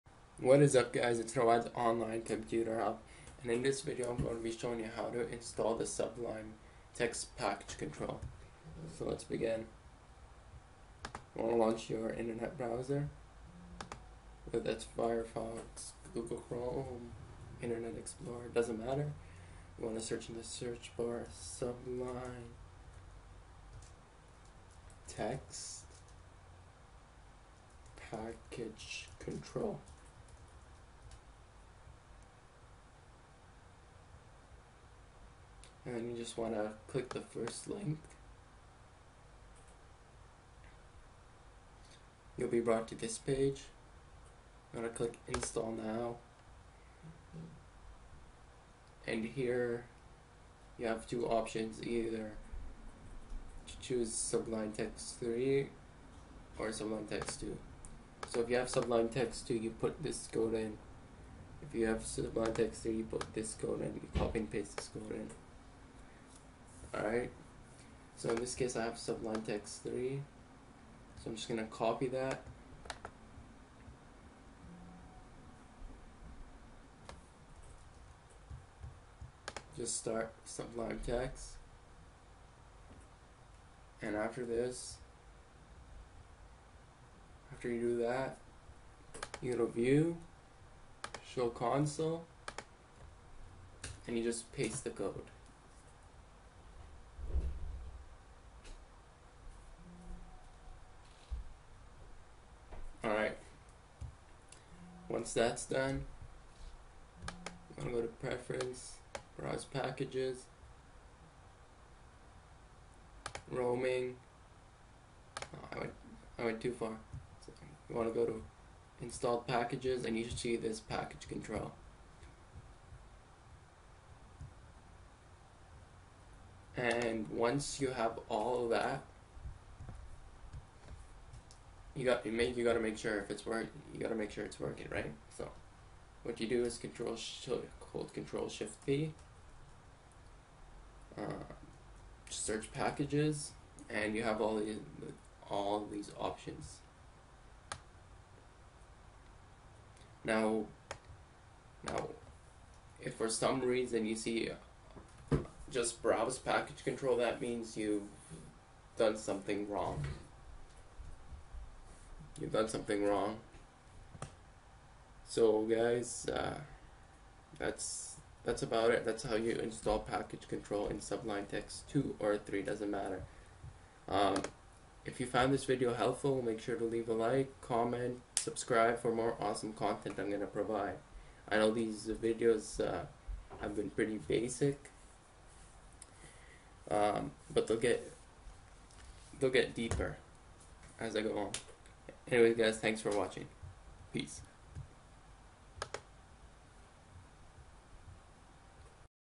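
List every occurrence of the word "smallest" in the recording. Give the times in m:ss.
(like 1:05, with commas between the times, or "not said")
not said.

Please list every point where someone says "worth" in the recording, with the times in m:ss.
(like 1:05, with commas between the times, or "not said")
not said.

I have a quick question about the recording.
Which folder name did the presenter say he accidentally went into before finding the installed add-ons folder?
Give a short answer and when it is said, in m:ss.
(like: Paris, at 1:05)
Roaming, at 1:53.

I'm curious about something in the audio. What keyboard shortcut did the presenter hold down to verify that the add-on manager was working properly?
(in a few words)
Control Shift P.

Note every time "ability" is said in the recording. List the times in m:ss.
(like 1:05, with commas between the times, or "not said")
not said.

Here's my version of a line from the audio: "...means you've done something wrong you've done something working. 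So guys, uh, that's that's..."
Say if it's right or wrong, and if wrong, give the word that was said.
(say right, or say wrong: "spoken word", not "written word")
wrong: "wrong", not "working".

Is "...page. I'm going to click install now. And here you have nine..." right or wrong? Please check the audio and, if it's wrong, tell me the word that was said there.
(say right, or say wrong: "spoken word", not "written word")
wrong: "two", not "nine".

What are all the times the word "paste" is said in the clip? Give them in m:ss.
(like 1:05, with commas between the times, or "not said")
1:04, 1:34.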